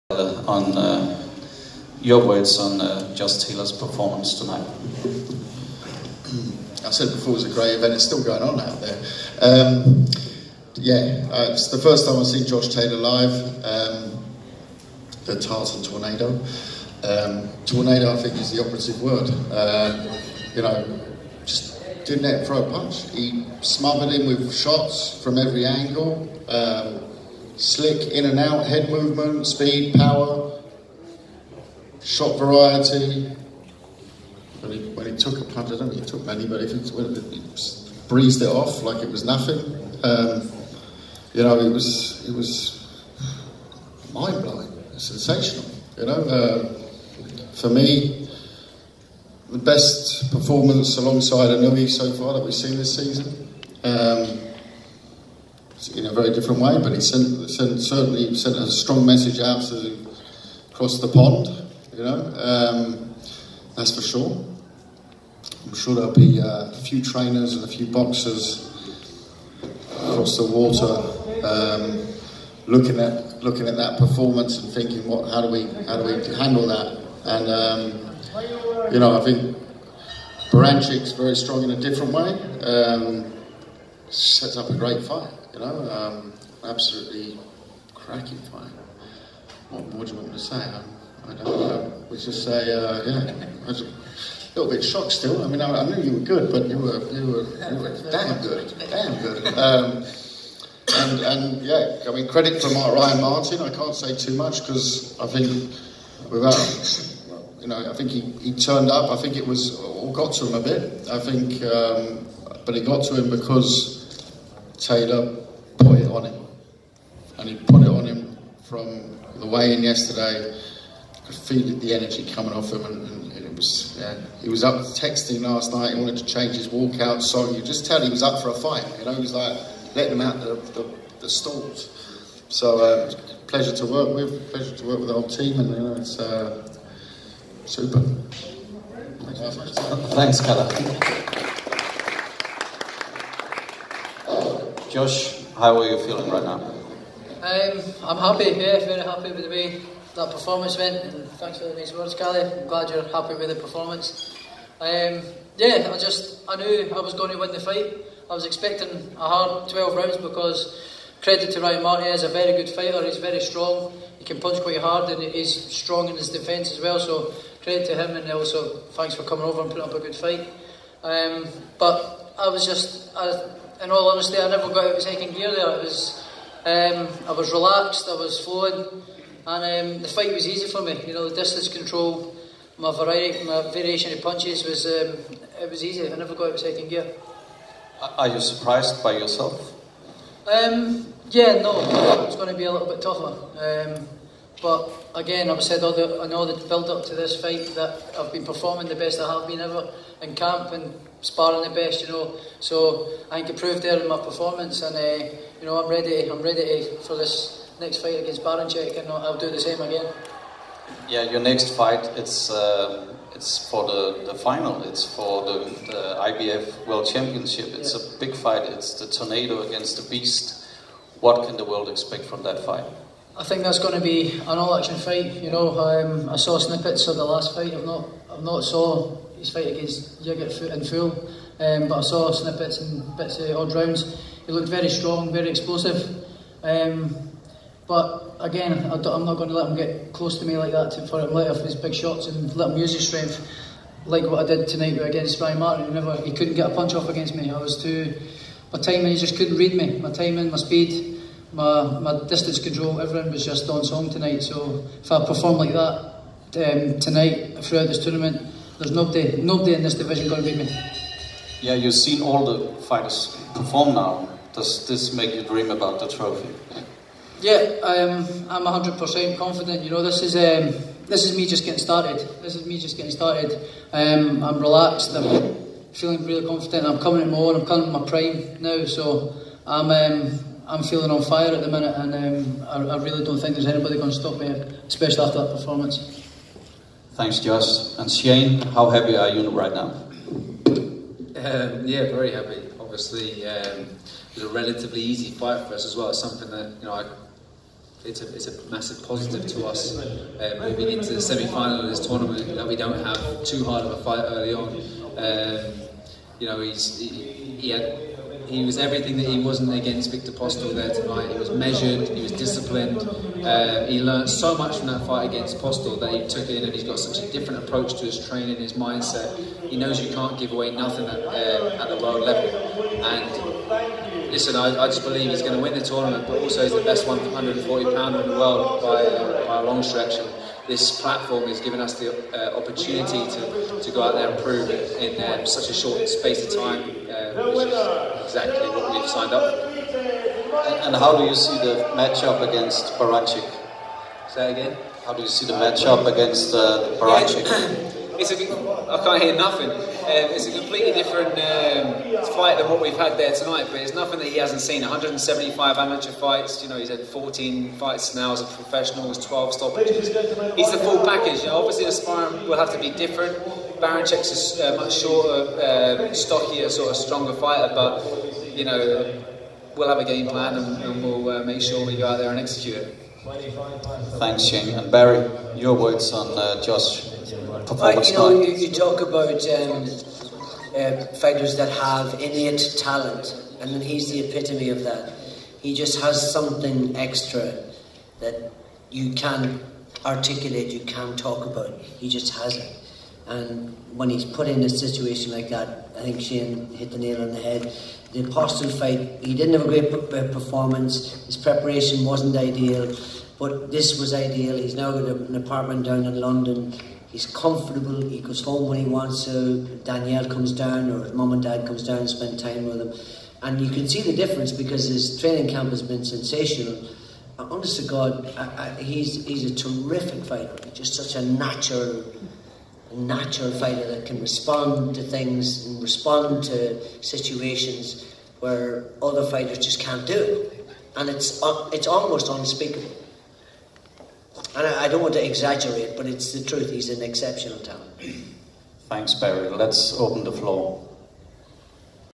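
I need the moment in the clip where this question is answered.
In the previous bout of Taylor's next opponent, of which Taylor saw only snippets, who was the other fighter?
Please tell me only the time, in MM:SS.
03:50.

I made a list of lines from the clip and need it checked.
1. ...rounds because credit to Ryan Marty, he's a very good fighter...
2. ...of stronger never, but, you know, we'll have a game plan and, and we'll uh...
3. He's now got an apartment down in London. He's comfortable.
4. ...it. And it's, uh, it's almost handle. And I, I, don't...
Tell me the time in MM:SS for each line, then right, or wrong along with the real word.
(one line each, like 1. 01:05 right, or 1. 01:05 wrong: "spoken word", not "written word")
1. 02:39 right
2. 06:06 wrong: "fighter", not "never"
3. 06:44 right
4. 07:10 wrong: "unspeakable", not "handle".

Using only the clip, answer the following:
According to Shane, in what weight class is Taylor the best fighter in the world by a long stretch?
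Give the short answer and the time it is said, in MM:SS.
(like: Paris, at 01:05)
140 pounds, at 05:27.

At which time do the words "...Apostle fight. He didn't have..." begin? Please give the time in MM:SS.
06:38.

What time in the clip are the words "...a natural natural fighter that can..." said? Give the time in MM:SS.
07:01.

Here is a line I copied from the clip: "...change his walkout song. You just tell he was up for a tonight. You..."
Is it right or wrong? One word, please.
wrong.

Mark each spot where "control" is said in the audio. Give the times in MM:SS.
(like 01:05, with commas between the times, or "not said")
03:01, 04:12.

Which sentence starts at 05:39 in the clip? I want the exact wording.
And, and how do you see the matchup against Baranchik?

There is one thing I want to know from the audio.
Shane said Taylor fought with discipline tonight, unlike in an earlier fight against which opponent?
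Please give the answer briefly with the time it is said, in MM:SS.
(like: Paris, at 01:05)
Viktor Postol, at 05:10.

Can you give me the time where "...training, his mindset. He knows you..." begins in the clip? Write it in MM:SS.
05:18.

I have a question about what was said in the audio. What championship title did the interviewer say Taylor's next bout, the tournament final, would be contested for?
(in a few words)
IBF World Championship.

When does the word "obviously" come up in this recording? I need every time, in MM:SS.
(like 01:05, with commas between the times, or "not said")
04:52, 06:01.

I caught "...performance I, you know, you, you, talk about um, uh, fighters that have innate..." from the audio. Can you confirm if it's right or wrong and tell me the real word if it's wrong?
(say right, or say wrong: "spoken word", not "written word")
right.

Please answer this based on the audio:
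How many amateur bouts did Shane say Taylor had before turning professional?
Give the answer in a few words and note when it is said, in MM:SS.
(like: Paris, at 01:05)
175, at 05:54.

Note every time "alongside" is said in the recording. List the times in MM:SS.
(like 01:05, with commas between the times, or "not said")
00:50.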